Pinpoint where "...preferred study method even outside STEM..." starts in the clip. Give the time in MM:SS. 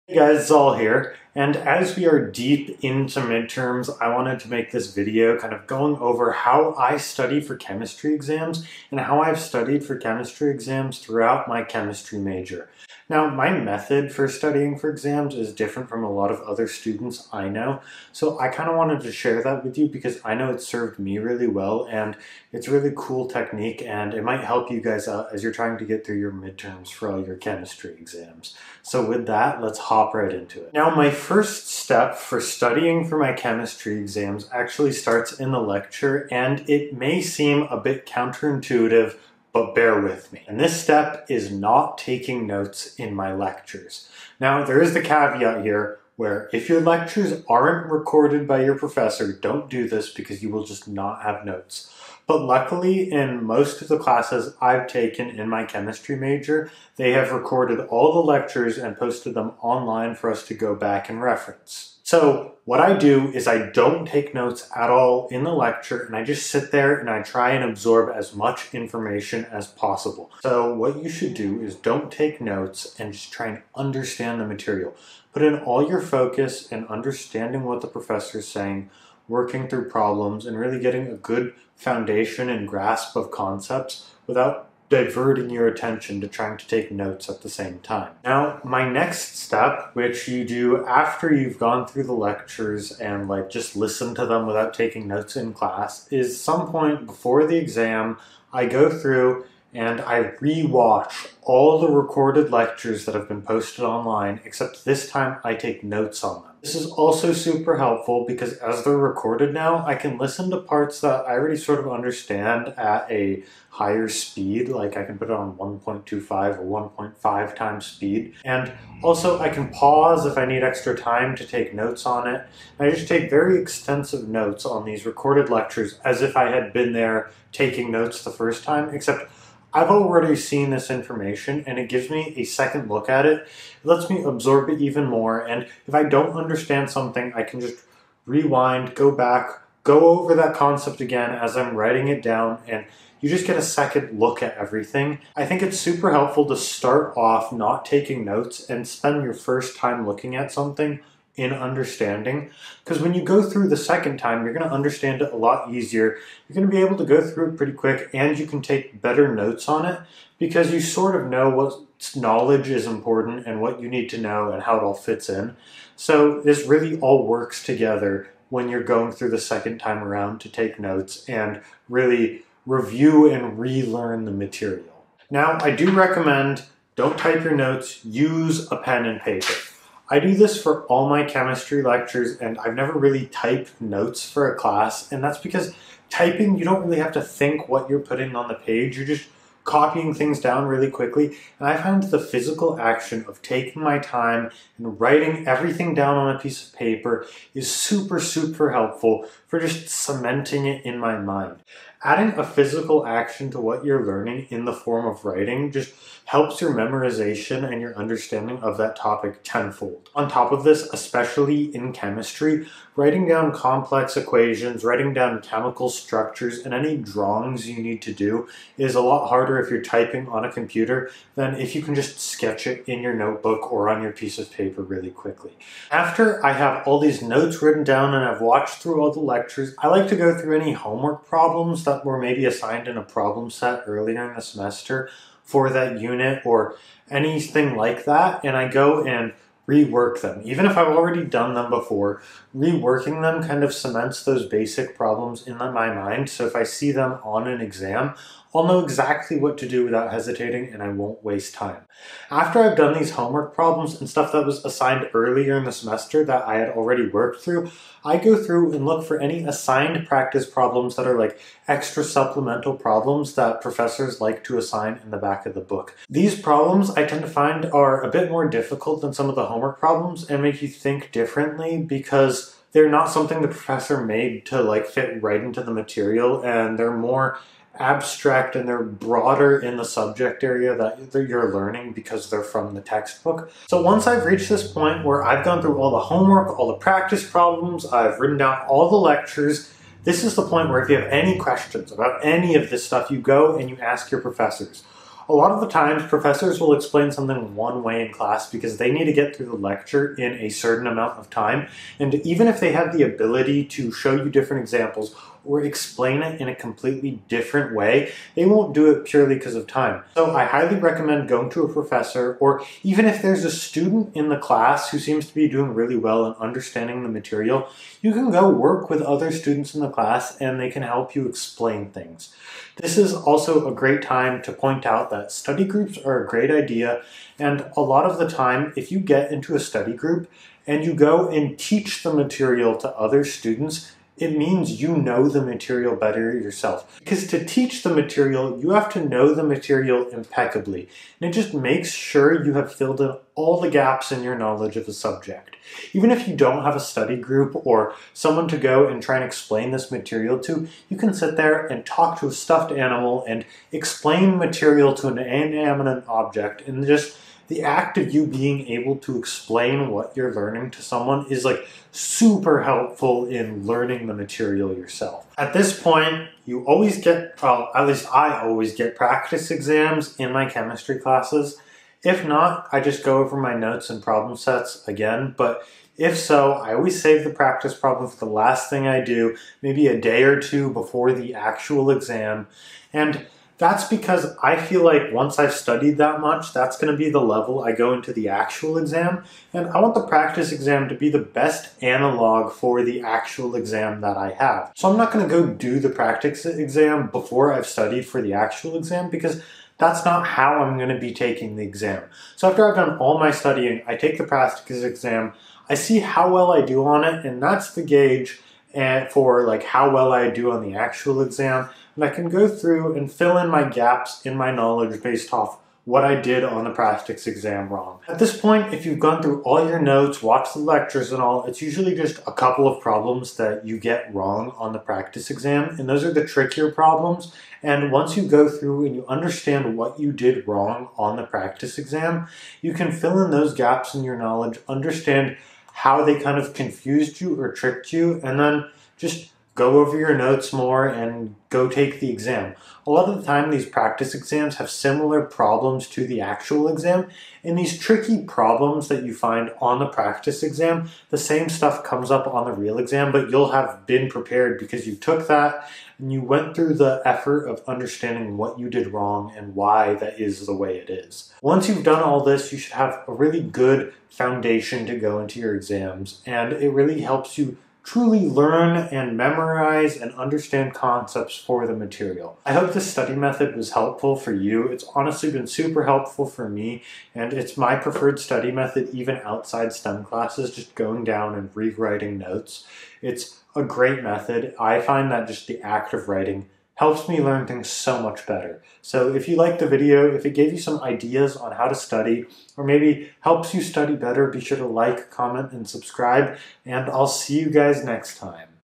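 07:57.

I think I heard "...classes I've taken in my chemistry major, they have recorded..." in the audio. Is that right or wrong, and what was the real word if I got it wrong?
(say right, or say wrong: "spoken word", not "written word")
right.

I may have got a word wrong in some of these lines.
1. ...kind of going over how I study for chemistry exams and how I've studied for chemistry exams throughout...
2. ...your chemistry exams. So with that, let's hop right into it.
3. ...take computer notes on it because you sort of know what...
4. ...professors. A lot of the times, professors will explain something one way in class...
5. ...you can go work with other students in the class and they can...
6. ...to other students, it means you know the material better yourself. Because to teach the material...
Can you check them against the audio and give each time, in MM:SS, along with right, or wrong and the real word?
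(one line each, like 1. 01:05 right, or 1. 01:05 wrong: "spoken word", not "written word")
1. 00:05 right
2. 00:27 right
3. 02:38 wrong: "better", not "computer"
4. 04:54 right
5. 05:18 right
6. 05:32 right.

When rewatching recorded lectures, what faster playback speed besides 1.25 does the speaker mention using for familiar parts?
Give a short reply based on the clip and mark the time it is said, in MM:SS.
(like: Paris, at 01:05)
1.5 times, at 01:56.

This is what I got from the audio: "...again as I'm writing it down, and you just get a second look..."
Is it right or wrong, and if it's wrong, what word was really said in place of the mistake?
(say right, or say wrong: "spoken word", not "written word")
right.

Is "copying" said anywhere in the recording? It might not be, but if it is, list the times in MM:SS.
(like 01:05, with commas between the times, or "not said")
03:09.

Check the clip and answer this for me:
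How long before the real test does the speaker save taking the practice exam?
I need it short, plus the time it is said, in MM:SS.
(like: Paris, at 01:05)
a day or two, at 06:19.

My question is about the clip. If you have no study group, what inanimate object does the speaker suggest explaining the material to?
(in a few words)
a stuffed animal.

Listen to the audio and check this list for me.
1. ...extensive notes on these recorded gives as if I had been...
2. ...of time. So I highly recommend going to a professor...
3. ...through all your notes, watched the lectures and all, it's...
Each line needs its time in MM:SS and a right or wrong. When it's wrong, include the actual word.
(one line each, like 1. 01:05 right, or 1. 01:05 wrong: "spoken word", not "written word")
1. 02:03 wrong: "lectures", not "gives"
2. 05:09 right
3. 06:59 right.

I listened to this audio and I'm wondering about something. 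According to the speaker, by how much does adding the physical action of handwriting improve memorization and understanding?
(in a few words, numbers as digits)
tenfold.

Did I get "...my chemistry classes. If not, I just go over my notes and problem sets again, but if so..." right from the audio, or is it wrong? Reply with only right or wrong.
right.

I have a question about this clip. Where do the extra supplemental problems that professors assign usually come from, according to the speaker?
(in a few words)
back of the book.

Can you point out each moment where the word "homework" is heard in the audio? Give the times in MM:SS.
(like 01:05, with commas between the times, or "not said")
03:50, 04:13, 04:29, 04:45.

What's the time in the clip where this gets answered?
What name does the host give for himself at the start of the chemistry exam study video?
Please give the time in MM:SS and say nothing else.
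00:00.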